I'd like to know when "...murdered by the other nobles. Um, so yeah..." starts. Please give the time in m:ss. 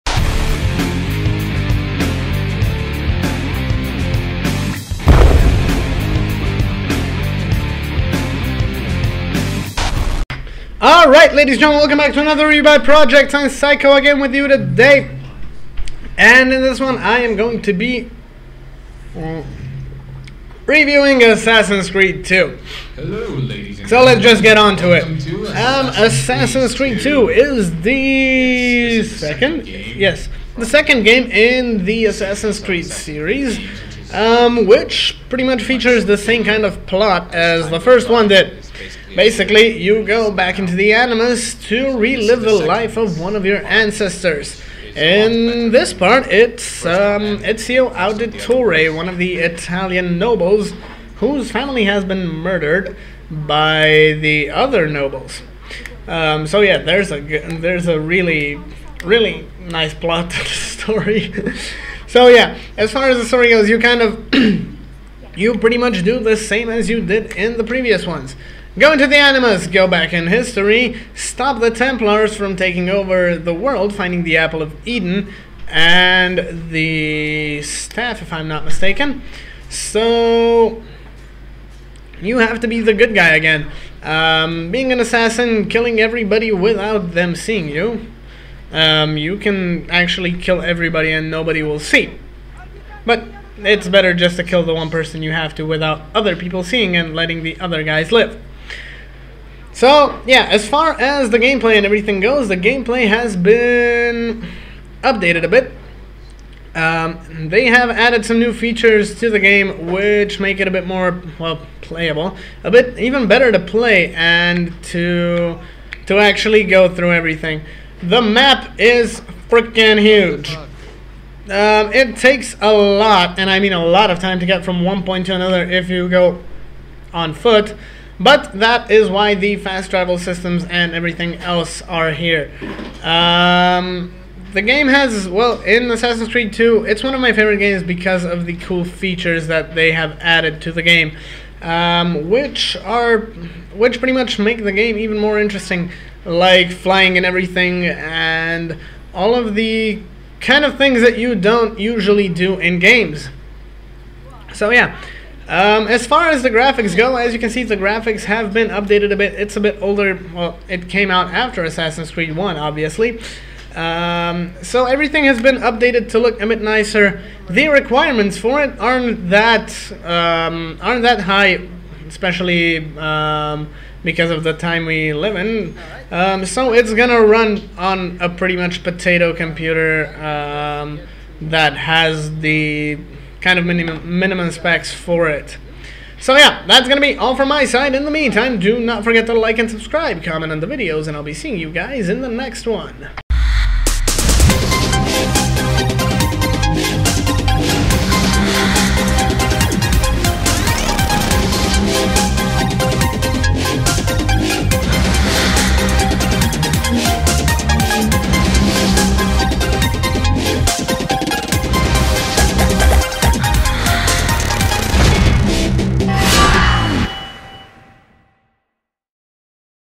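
0:52.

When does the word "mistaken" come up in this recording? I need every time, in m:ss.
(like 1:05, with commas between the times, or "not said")
1:18.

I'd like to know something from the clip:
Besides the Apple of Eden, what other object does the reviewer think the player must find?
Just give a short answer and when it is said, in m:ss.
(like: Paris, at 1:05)
the staff, at 1:16.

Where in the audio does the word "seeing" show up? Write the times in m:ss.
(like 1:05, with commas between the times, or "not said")
1:27, 1:36, 3:11.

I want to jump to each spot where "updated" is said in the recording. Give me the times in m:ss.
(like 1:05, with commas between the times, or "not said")
1:45, 2:38, 2:45.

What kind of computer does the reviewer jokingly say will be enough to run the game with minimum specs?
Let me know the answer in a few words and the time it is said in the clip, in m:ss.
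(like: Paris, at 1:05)
potato computer, at 2:58.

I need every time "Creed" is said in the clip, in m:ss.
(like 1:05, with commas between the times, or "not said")
0:21, 0:26, 0:32, 2:16, 2:42.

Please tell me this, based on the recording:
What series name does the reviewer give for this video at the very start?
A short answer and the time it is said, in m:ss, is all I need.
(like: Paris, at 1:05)
Rebuy Project, at 0:12.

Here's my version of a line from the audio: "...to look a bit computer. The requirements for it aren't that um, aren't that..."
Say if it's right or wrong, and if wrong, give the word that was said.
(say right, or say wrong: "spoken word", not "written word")
wrong: "nicer", not "computer".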